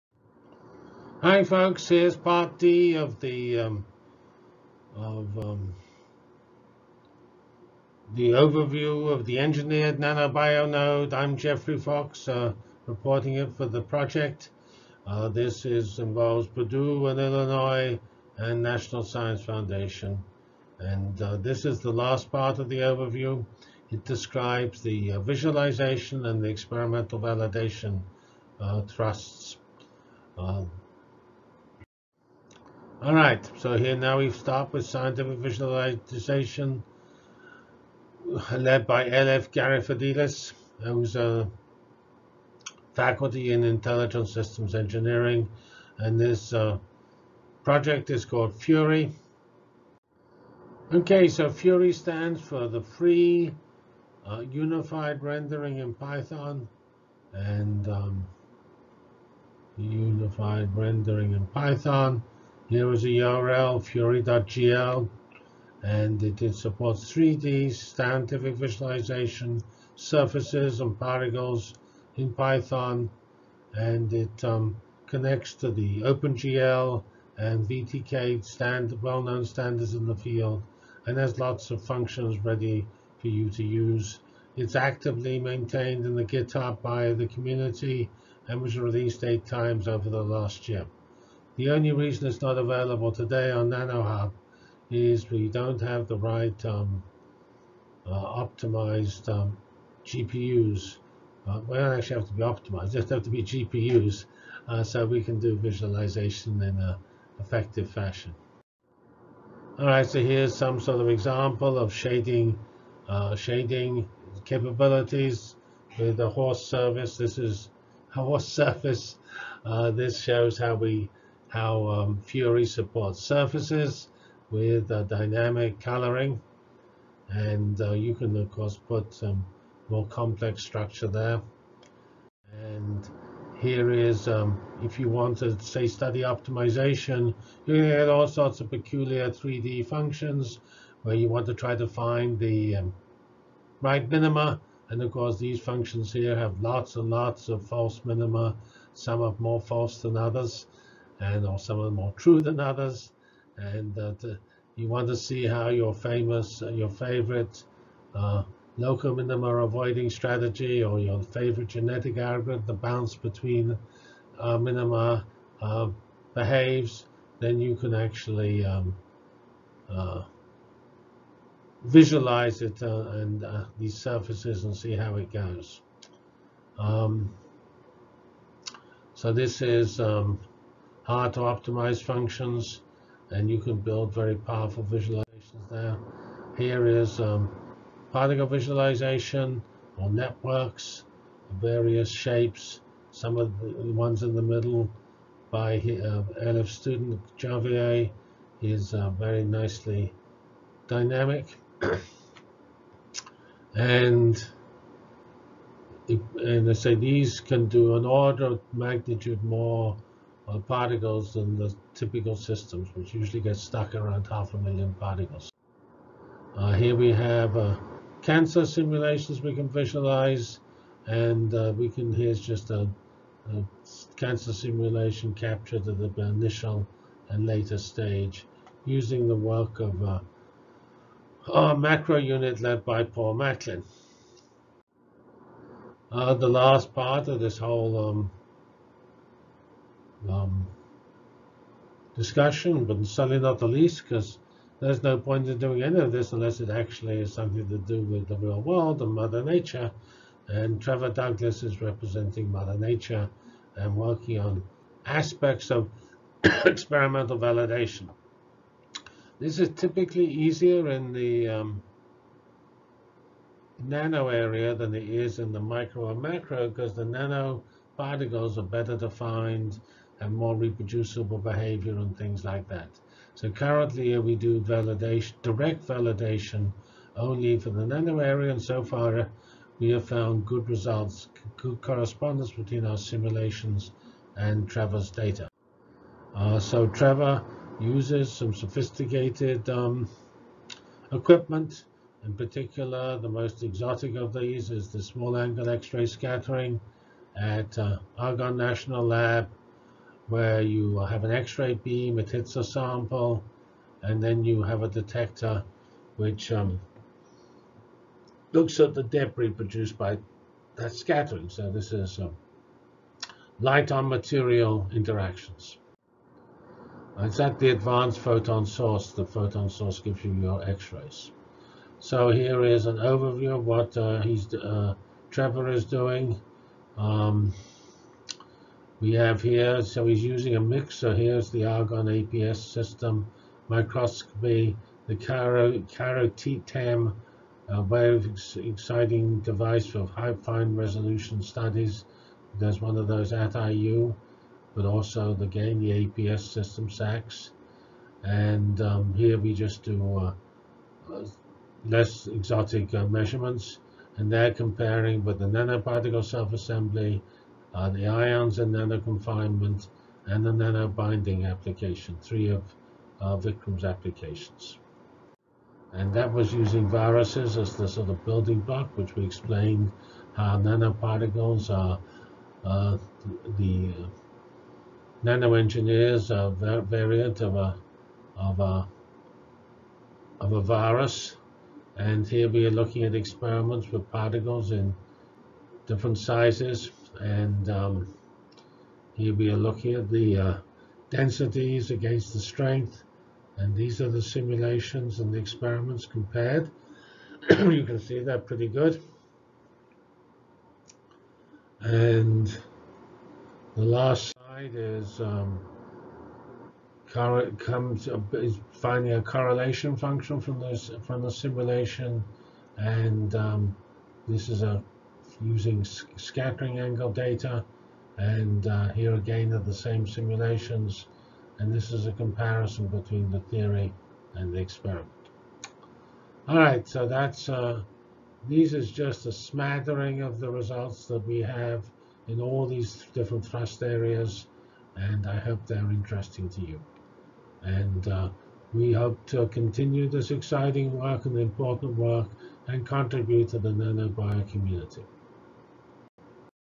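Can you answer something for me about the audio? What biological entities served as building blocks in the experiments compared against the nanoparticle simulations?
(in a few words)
Viruses.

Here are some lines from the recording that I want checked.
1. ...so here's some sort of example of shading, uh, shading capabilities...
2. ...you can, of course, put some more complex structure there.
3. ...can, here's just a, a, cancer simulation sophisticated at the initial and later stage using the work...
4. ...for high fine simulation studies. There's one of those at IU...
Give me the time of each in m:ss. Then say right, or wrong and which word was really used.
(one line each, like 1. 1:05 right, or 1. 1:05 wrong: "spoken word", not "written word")
1. 1:50 right
2. 2:07 right
3. 3:41 wrong: "captured", not "sophisticated"
4. 5:39 wrong: "resolution", not "simulation".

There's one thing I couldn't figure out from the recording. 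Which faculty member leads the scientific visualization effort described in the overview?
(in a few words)
L.F. Garyfallidis.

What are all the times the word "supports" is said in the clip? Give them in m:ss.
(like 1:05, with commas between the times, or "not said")
1:06, 2:02.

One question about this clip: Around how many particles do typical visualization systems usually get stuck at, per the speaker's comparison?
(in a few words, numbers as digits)
Half a million.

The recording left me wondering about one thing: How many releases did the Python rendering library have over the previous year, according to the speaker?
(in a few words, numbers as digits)
8.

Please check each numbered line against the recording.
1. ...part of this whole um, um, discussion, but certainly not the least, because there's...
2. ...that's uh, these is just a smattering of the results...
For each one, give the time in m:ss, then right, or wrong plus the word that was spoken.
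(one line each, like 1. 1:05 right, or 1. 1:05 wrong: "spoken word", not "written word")
1. 3:56 right
2. 7:07 right.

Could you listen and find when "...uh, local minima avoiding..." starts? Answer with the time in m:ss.
2:38.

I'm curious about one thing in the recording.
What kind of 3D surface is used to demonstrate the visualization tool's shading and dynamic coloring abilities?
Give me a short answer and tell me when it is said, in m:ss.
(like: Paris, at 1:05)
Horse surface, at 1:58.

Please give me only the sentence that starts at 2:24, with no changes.
And of course, these functions here have lots and lots of false minima.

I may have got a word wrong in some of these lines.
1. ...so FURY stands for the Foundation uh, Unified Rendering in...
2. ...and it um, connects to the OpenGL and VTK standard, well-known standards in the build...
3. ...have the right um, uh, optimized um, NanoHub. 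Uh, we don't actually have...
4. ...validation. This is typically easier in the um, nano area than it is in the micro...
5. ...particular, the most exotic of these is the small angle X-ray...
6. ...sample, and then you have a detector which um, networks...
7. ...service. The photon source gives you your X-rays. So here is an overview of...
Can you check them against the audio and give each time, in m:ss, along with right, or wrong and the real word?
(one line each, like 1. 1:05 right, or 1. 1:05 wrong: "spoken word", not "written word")
1. 0:51 wrong: "Free", not "Foundation"
2. 1:13 wrong: "field", not "build"
3. 1:35 wrong: "GPUs", not "NanoHub"
4. 4:17 right
5. 4:52 right
6. 5:02 wrong: "looks", not "networks"
7. 5:18 wrong: "source", not "service".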